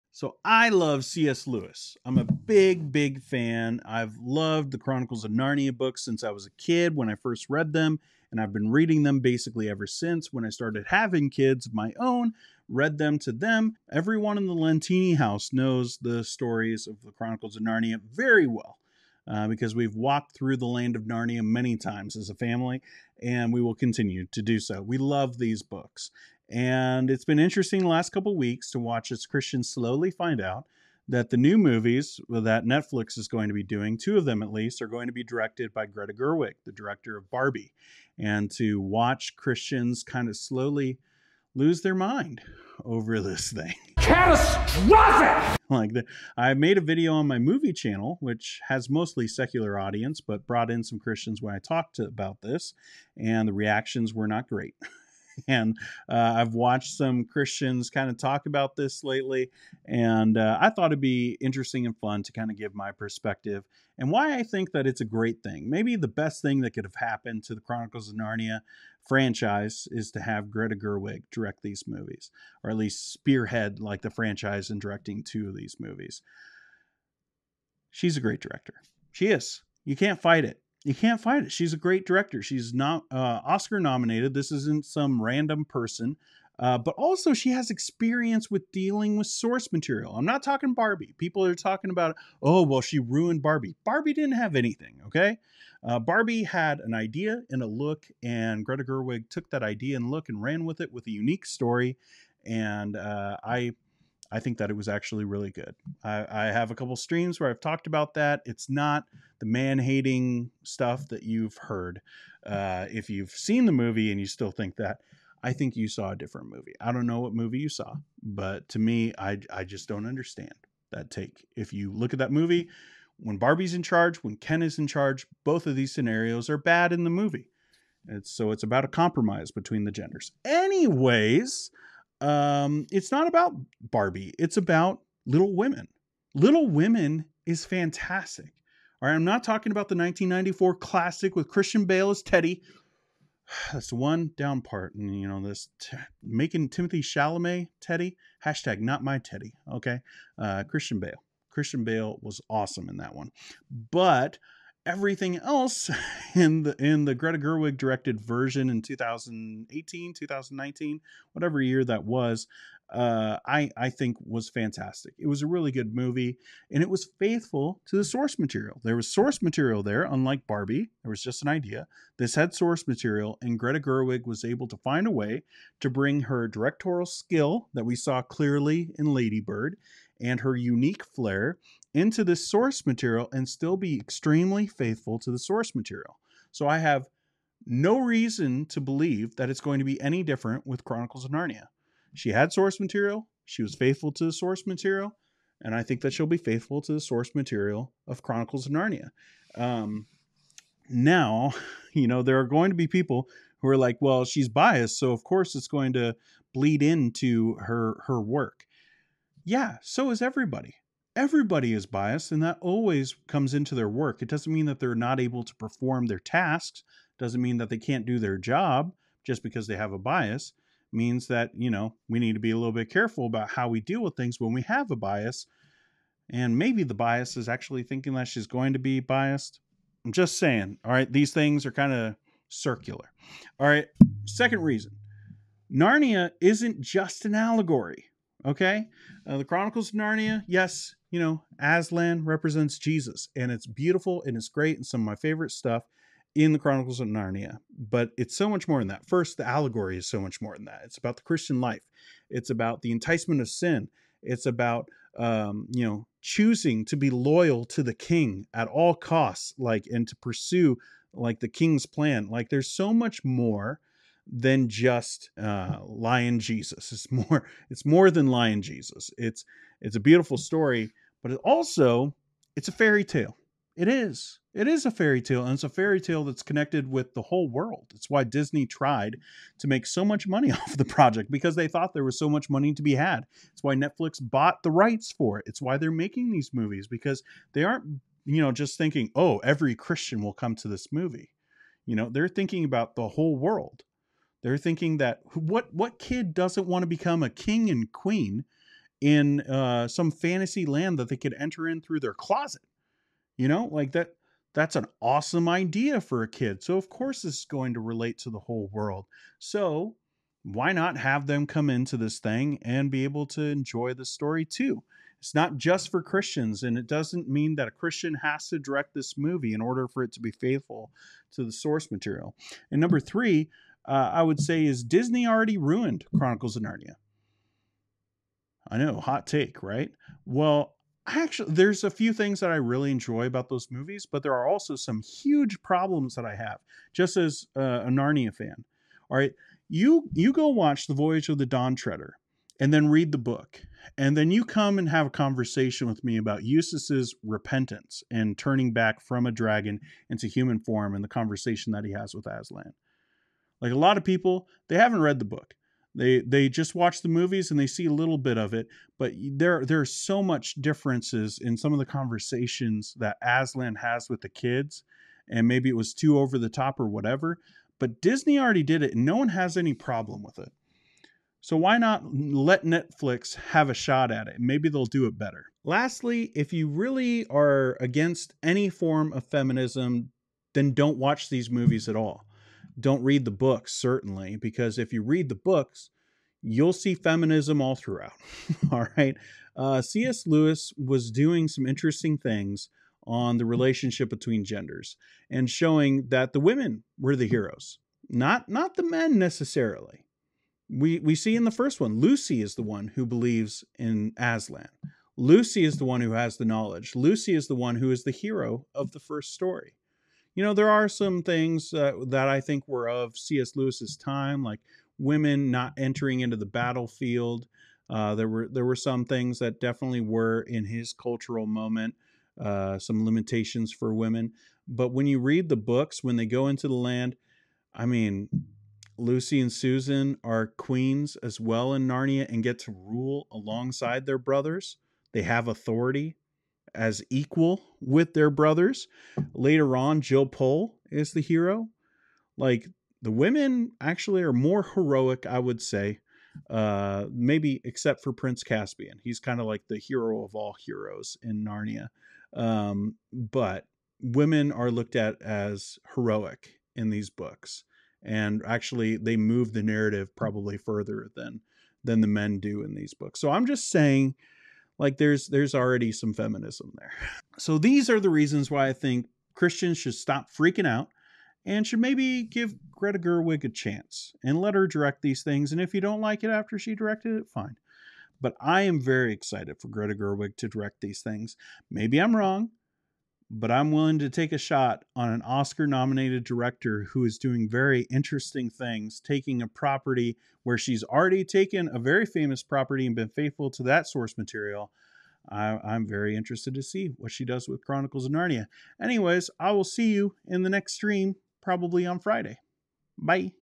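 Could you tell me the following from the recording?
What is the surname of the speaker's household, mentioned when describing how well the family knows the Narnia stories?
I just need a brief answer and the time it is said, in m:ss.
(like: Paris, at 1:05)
Lentini, at 0:14.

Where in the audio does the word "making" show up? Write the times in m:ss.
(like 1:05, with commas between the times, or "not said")
2:26, 4:45.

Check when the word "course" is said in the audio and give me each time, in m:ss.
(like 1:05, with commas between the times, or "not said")
3:25, 5:06.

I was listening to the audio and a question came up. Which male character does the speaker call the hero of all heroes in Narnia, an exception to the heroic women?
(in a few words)
Prince Caspian.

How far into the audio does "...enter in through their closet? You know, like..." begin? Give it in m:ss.
5:01.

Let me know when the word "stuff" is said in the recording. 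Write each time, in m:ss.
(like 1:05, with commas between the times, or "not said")
1:50, 4:05.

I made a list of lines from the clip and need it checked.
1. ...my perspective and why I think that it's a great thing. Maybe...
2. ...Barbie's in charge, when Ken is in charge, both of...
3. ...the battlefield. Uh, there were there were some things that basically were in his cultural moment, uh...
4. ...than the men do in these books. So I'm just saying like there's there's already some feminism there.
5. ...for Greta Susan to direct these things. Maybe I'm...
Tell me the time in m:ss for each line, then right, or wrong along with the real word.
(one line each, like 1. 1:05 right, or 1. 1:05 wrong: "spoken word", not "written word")
1. 1:02 right
2. 2:03 right
3. 6:56 wrong: "definitely", not "basically"
4. 7:41 right
5. 7:59 wrong: "Gerwig", not "Susan".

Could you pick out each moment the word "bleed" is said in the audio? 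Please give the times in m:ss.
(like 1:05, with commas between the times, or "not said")
3:26.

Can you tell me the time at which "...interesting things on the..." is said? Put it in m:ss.
6:31.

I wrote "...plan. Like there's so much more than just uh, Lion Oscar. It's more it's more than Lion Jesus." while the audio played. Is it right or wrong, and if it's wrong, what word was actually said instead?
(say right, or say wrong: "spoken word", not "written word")
wrong: "Jesus", not "Oscar".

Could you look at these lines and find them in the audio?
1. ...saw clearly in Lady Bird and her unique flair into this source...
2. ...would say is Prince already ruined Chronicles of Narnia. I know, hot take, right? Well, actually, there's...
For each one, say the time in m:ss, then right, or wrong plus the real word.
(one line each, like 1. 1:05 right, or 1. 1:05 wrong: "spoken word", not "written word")
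1. 2:57 right
2. 5:24 wrong: "Disney", not "Prince".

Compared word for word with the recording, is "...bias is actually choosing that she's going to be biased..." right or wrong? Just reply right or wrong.
wrong.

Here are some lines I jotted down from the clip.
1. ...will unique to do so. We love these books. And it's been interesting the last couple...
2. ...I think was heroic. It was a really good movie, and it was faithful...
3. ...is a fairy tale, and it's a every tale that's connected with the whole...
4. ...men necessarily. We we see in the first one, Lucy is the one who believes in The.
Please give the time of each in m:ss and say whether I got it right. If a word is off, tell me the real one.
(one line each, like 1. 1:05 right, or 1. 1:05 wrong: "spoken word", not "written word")
1. 0:23 wrong: "continue", not "unique"
2. 2:43 wrong: "fantastic", not "heroic"
3. 4:34 wrong: "fairy", not "every"
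4. 6:38 wrong: "Aslan", not "The".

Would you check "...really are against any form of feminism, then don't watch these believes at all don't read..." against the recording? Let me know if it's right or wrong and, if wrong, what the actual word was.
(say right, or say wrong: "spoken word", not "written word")
wrong: "movies", not "believes".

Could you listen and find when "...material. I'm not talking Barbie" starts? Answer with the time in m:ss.
1:29.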